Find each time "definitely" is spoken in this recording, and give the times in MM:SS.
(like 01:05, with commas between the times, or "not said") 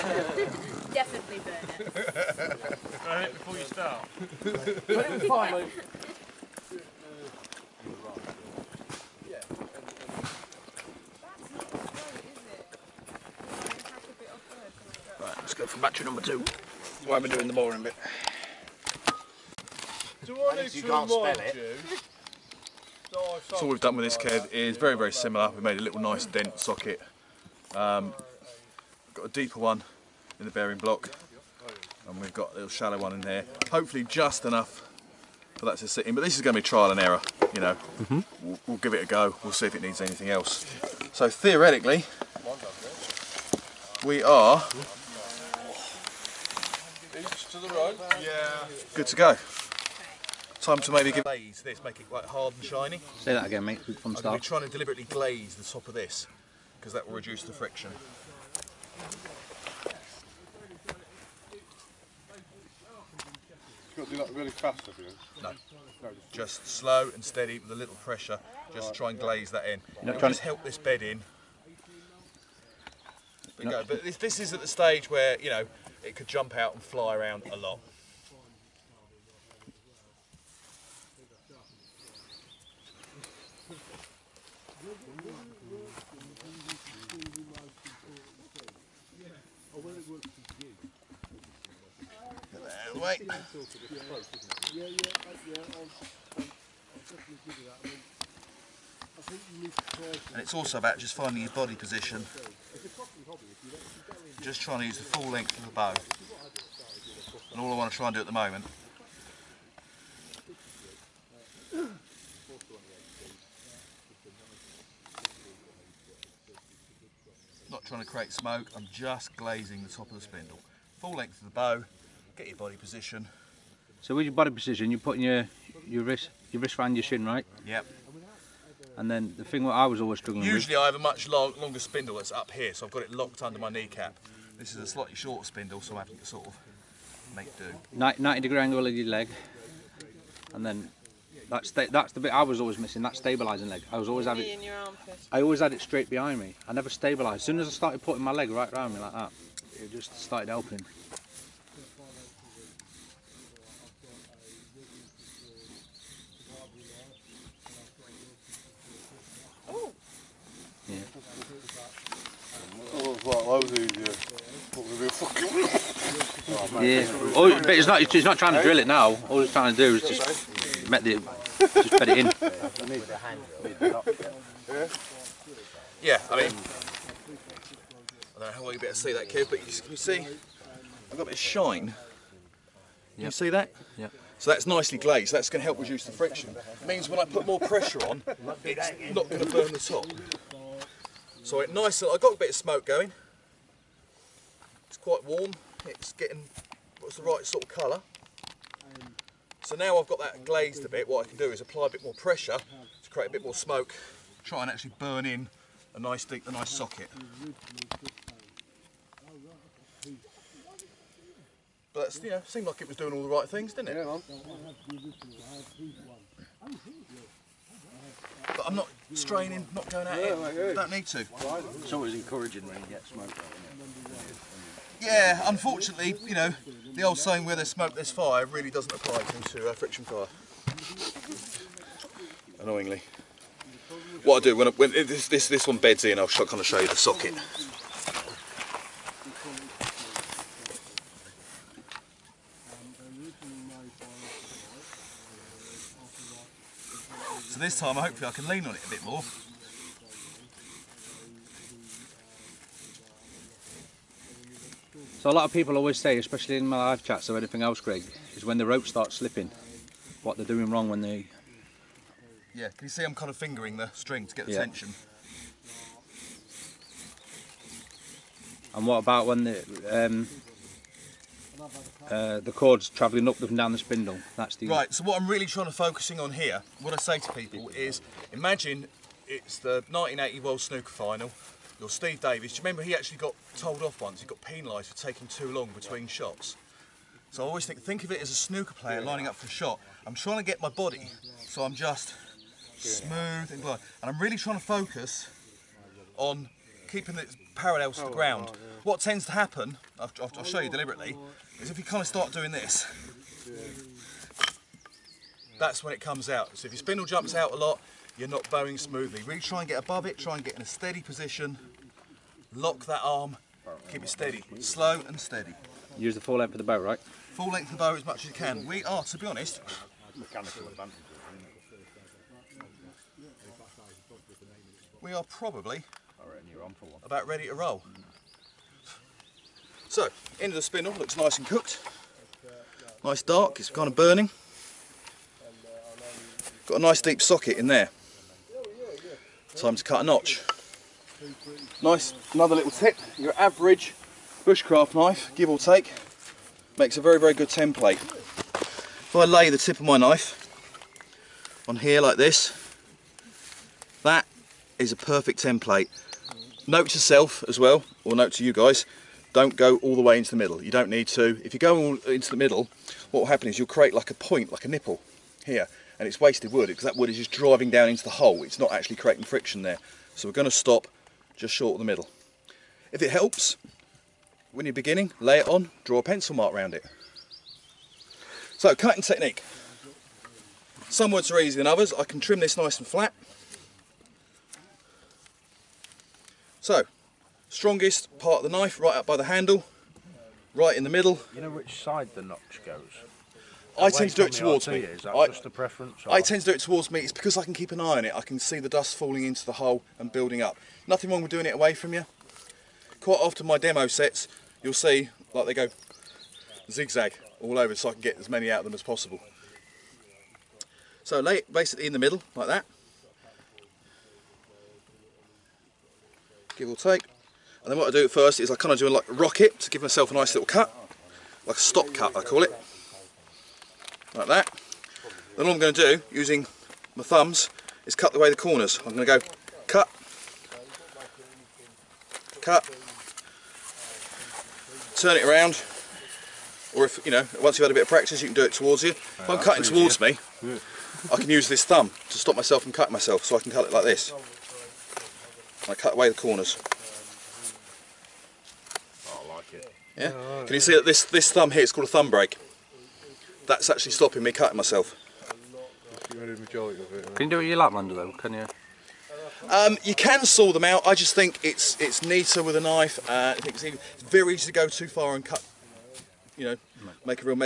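00:00, 01:35.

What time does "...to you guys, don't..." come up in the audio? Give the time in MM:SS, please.
05:58.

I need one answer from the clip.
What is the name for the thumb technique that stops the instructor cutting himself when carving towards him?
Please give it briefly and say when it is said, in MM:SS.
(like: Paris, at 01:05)
Thumb break, at 07:31.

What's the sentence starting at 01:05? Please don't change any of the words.
no just, just slow and steady with a little pressure.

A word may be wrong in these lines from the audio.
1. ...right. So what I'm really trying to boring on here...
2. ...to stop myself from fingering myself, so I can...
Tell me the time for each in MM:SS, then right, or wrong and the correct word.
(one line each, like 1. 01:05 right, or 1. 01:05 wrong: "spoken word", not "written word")
1. 04:34 wrong: "focusing", not "boring"
2. 07:22 wrong: "cutting", not "fingering".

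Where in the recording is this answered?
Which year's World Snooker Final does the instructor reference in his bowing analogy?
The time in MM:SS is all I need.
04:39.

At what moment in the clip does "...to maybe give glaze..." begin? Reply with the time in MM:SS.
00:50.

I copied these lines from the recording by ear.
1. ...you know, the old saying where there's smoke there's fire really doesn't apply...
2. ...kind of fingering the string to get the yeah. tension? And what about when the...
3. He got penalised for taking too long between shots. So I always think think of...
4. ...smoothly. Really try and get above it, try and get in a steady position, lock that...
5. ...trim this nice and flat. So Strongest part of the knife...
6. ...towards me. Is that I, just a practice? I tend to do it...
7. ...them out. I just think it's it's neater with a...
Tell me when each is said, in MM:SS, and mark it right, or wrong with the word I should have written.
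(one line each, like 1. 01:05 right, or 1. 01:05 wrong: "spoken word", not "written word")
1. 03:46 right
2. 04:23 right
3. 04:44 right
4. 05:08 right
5. 06:22 right
6. 06:34 wrong: "preference", not "practice"
7. 07:40 right.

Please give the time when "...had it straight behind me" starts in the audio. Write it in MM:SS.
02:25.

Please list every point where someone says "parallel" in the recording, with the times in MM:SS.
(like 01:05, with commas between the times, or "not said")
04:57.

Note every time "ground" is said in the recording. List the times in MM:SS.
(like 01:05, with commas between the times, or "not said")
04:58.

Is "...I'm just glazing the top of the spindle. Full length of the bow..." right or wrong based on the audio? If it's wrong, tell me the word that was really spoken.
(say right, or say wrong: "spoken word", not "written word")
right.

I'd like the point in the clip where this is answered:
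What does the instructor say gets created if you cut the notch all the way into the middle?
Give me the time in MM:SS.
06:04.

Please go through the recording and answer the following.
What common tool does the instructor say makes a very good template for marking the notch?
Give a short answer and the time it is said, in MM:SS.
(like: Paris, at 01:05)
Bushcraft knife, at 05:44.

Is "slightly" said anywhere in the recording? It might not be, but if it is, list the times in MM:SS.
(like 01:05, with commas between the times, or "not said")
02:14.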